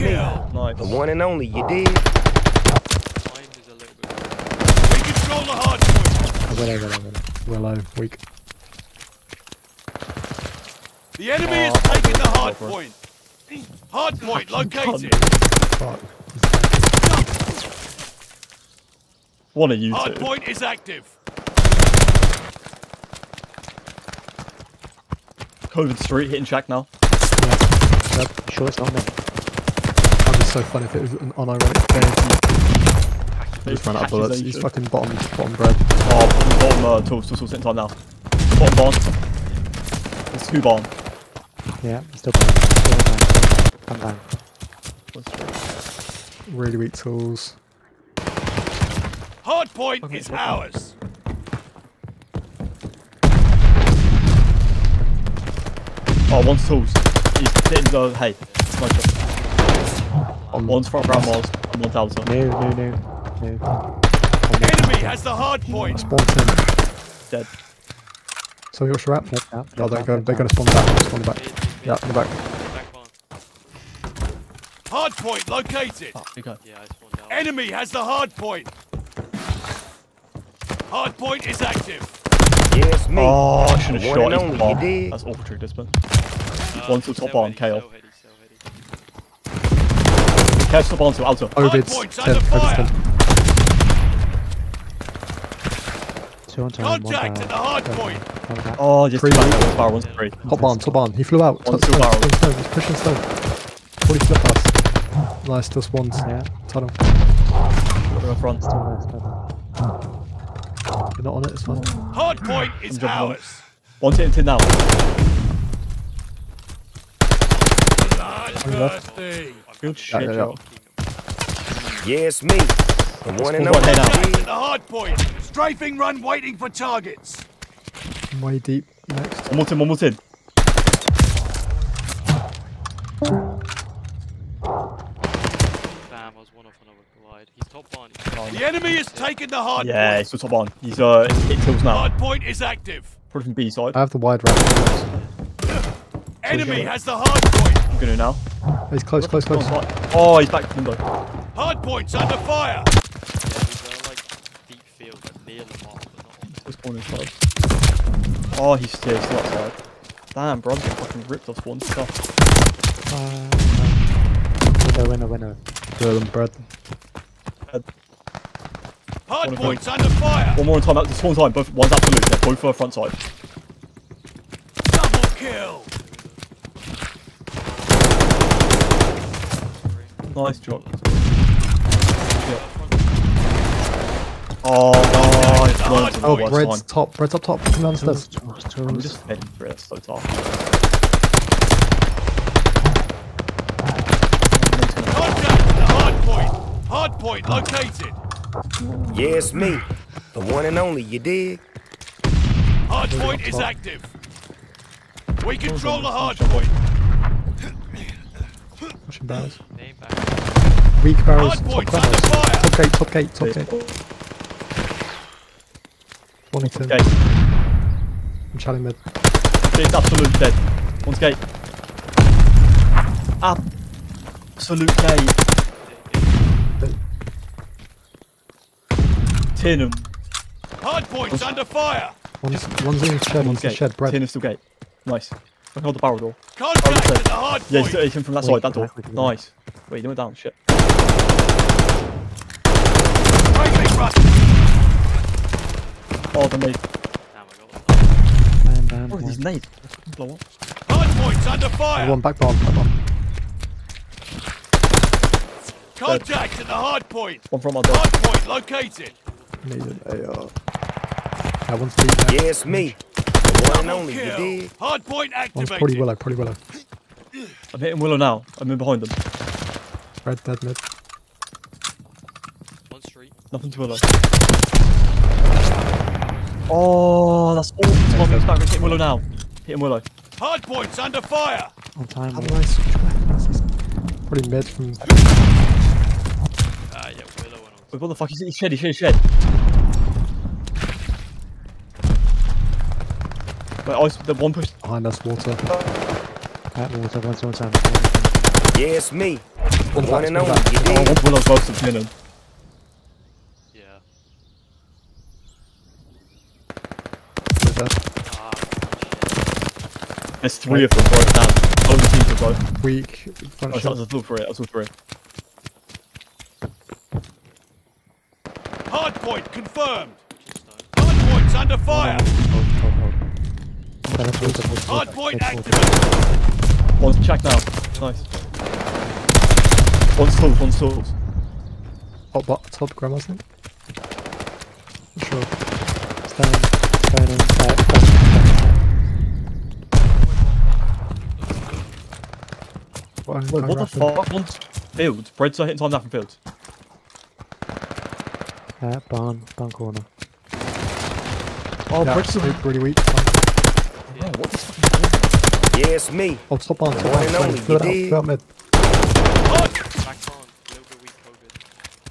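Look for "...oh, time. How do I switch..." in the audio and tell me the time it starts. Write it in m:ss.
4:42.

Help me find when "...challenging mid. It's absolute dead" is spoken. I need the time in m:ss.
3:38.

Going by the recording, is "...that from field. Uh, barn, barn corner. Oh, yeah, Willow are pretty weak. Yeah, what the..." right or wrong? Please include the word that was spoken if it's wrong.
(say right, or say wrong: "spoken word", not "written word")
wrong: "Breads", not "Willow".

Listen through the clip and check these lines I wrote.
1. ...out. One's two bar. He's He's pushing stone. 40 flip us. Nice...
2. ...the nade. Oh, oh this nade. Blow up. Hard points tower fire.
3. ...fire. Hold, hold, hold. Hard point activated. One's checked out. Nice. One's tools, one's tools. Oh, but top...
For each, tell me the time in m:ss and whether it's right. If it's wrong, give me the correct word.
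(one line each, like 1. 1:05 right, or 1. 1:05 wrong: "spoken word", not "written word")
1. 1:41 right
2. 4:06 wrong: "under", not "tower"
3. 5:21 right.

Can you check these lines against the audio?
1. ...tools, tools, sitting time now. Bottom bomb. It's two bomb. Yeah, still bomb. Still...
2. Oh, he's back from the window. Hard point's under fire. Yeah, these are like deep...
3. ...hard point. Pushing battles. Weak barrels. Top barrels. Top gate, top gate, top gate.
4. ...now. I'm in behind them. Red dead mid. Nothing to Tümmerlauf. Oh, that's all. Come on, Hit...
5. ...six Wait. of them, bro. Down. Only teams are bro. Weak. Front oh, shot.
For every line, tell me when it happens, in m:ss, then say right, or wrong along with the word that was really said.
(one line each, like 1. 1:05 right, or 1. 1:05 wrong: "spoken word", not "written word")
1. 0:37 right
2. 2:30 right
3. 3:26 right
4. 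4:28 right
5. 5:10 wrong: "three", not "six".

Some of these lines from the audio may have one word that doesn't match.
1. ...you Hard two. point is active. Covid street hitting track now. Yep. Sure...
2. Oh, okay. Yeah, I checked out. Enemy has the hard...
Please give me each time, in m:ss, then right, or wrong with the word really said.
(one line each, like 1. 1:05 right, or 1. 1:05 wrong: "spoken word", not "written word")
1. 0:19 right
2. 1:16 wrong: "spawned", not "checked".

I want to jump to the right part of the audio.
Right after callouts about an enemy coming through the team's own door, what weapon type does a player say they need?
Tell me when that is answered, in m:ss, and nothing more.
4:20.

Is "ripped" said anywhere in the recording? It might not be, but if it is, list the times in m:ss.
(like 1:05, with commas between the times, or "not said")
2:41.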